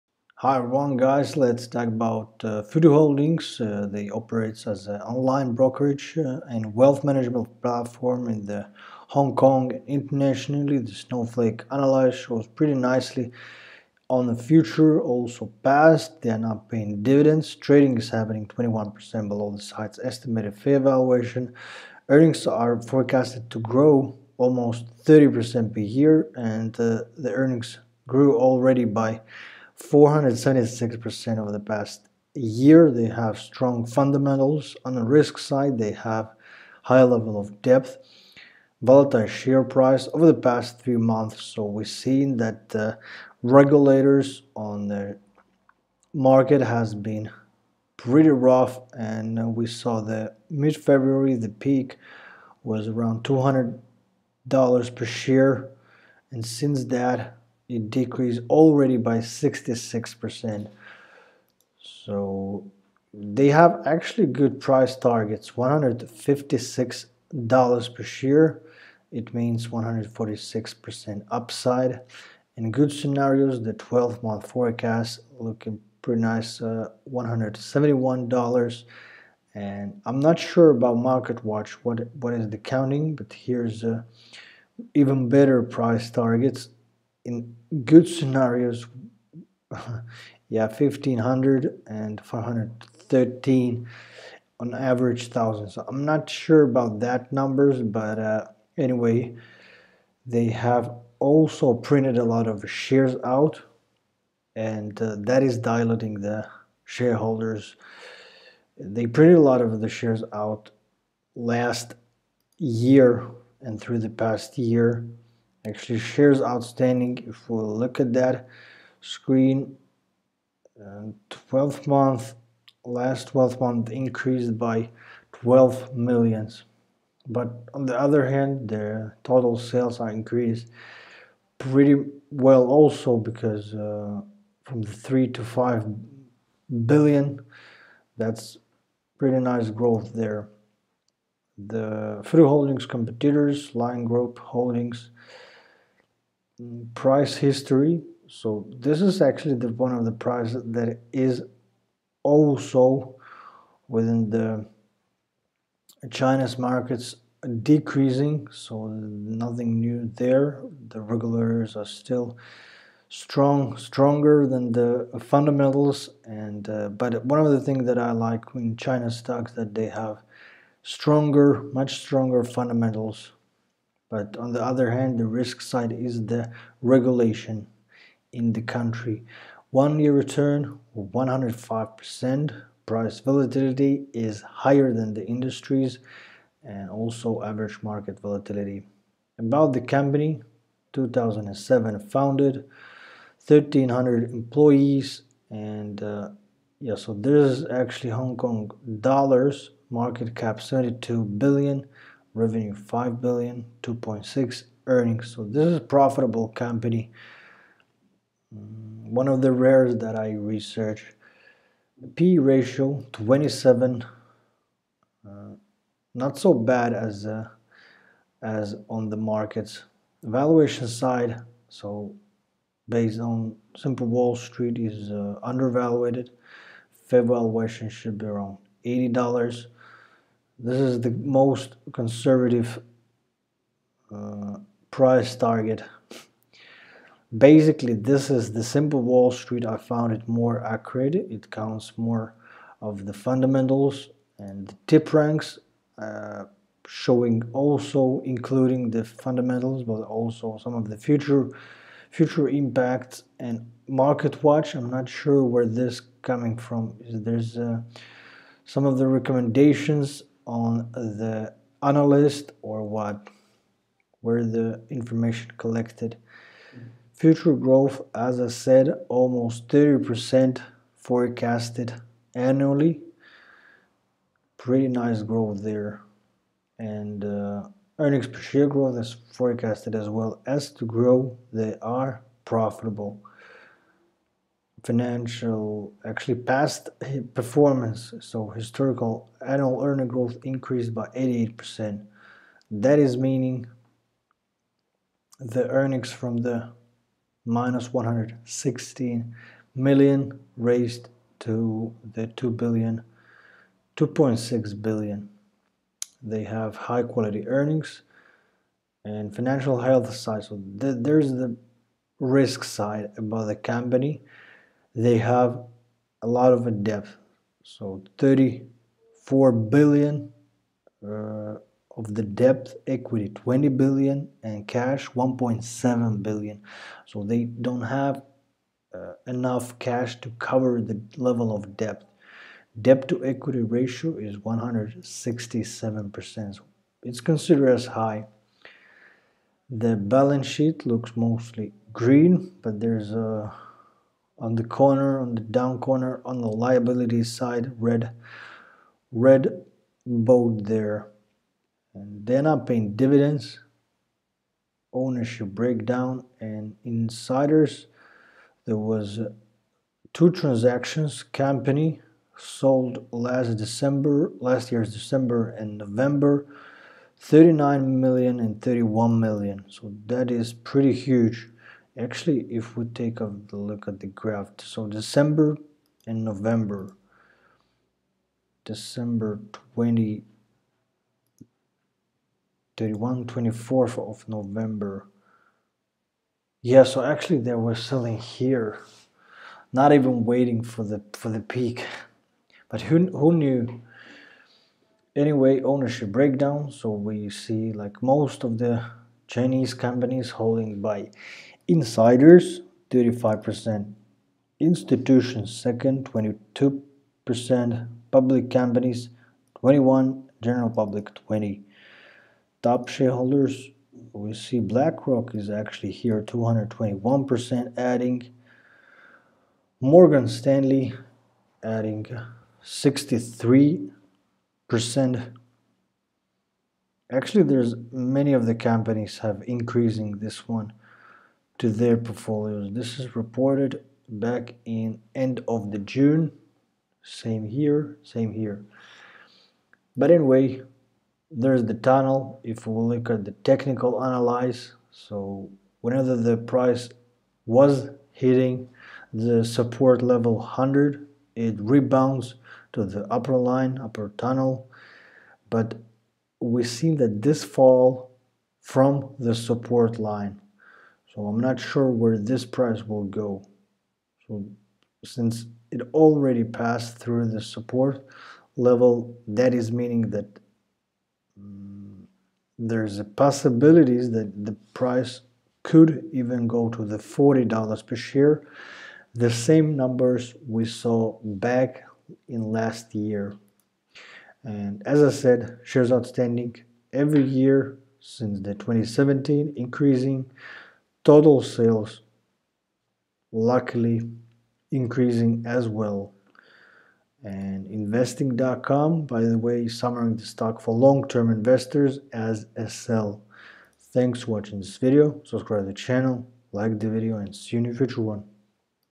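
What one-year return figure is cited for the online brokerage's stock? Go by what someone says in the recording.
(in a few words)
105%.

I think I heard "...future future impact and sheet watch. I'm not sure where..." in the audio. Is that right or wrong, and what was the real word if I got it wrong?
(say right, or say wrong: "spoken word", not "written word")
wrong: "market", not "sheet".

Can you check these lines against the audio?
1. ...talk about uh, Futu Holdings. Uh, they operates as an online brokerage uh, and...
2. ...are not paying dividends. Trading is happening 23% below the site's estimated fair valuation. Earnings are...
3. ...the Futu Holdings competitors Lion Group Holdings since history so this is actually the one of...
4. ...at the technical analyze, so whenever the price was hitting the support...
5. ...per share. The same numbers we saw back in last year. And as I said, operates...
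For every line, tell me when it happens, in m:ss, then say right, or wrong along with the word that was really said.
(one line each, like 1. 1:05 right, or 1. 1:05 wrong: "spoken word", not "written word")
1. 0:01 right
2. 0:16 wrong: "21", not "23"
3. 2:21 wrong: "price", not "since"
4. 7:23 right
5. 7:57 wrong: "shares", not "operates".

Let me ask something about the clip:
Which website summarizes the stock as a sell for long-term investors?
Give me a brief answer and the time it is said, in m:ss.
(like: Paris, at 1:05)
investing.com, at 8:17.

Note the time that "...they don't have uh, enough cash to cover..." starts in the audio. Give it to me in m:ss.
5:27.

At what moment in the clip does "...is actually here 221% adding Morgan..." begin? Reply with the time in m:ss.
6:55.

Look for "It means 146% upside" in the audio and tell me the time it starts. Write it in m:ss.
1:09.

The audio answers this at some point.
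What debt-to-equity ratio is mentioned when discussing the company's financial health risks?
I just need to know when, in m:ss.
5:34.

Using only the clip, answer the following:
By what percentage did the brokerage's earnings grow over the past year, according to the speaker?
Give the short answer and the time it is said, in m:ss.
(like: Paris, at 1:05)
476%, at 0:29.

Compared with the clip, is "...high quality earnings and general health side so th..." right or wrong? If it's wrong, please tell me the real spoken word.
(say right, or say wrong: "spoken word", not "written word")
wrong: "financial", not "general".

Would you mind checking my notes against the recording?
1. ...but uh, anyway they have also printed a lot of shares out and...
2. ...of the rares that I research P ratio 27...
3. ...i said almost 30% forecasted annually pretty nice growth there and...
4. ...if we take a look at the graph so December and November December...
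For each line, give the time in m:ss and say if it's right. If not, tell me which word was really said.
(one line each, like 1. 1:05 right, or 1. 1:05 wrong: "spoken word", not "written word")
1. 1:37 right
2. 3:29 right
3. 4:28 right
4. 6:12 right.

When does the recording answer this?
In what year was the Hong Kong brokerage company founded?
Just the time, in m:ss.
3:10.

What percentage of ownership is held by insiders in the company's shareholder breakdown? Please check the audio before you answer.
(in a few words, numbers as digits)
35%.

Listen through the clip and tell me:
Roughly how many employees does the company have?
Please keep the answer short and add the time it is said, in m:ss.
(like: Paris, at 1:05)
1300, at 3:13.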